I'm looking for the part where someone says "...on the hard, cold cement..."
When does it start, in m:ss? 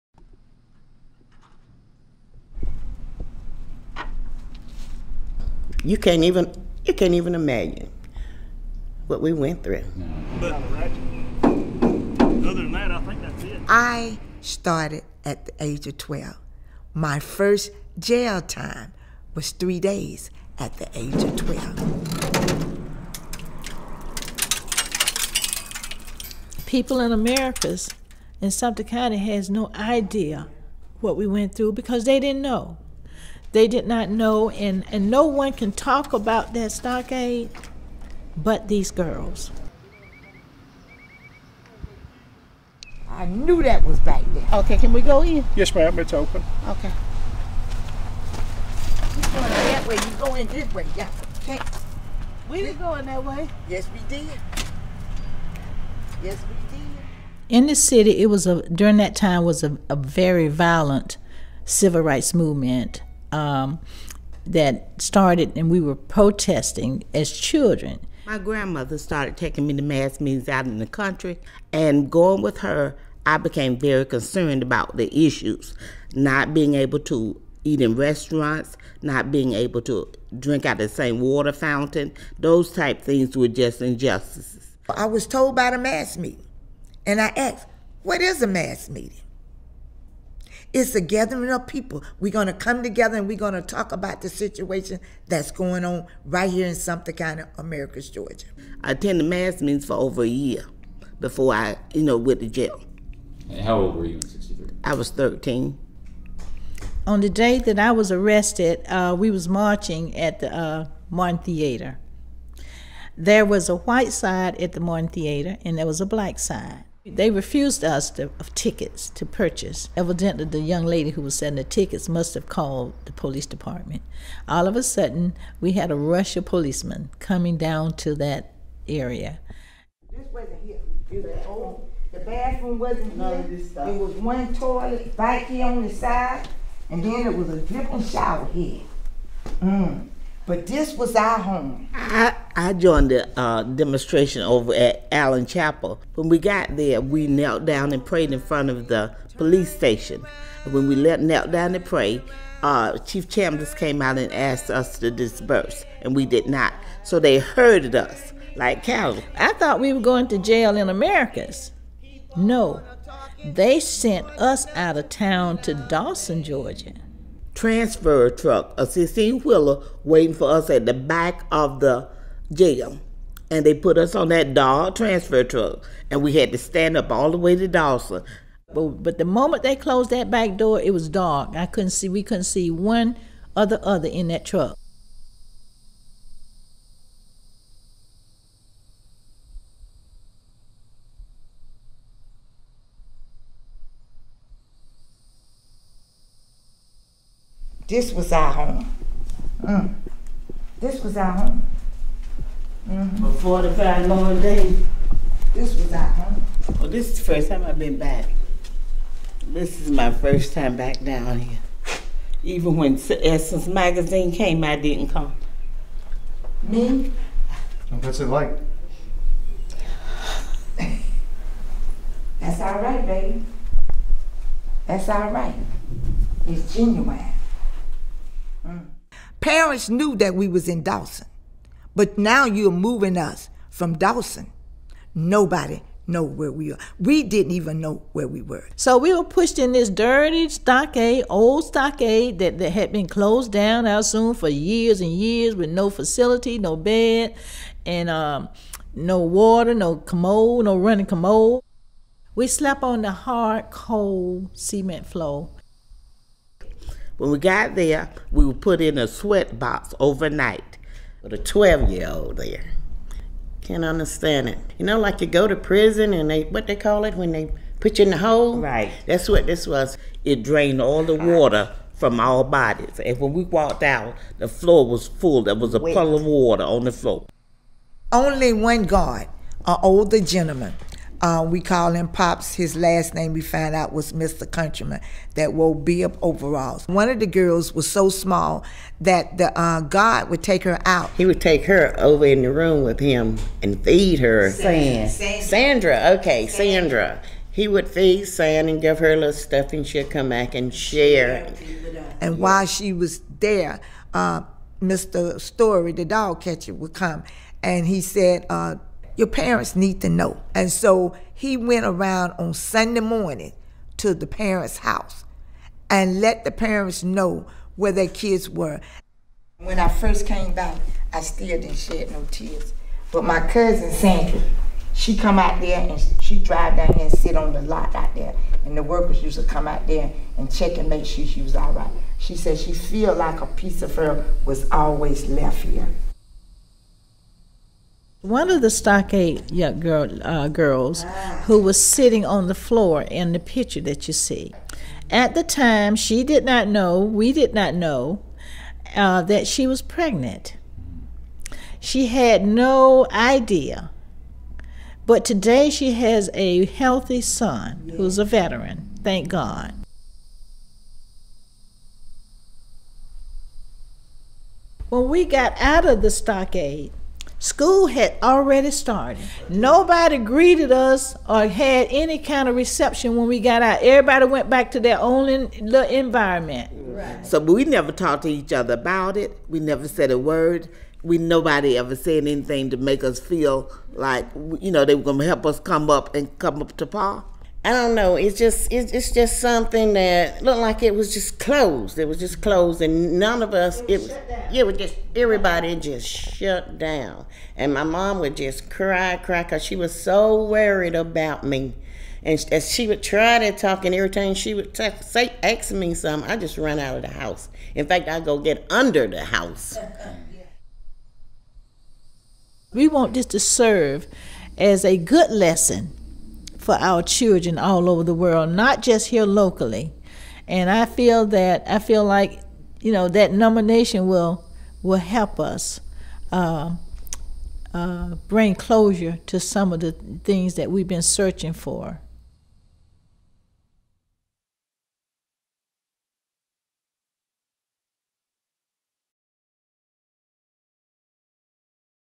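4:12.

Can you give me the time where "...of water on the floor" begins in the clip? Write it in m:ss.
4:36.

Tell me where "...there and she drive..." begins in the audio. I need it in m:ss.
5:25.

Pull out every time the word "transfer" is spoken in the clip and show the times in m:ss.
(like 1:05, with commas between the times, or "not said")
2:47, 2:54.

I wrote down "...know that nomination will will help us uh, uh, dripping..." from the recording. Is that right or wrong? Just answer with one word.
wrong.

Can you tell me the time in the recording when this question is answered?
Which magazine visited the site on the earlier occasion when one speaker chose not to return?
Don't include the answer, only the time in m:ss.
3:33.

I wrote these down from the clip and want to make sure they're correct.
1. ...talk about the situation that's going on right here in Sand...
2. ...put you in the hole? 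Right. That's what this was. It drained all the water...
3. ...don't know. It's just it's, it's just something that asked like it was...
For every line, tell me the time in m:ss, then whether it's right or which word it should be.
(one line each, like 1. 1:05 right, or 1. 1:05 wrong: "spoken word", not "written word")
1. 1:33 wrong: "Sumter", not "Sand"
2. 4:27 right
3. 6:27 wrong: "looked", not "asked".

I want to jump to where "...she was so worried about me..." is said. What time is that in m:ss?
6:39.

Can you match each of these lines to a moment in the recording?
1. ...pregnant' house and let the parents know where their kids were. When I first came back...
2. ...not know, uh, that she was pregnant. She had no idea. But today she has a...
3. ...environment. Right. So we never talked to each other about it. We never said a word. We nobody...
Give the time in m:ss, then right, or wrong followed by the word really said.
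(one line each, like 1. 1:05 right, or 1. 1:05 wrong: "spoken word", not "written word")
1. 5:14 wrong: "parents", not "pregnant"
2. 5:47 right
3. 6:15 right.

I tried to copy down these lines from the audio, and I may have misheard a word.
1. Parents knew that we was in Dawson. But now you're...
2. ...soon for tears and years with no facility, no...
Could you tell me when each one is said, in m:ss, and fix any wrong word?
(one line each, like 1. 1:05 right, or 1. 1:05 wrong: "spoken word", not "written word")
1. 3:49 right
2. 4:04 wrong: "years", not "tears".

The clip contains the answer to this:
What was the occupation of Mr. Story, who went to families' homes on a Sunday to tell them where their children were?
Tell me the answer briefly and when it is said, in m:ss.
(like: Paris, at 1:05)
dog catcher, at 5:05.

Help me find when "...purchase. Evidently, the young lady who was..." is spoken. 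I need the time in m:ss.
1:59.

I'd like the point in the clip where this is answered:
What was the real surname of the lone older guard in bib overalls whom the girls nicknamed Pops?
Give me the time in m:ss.
4:44.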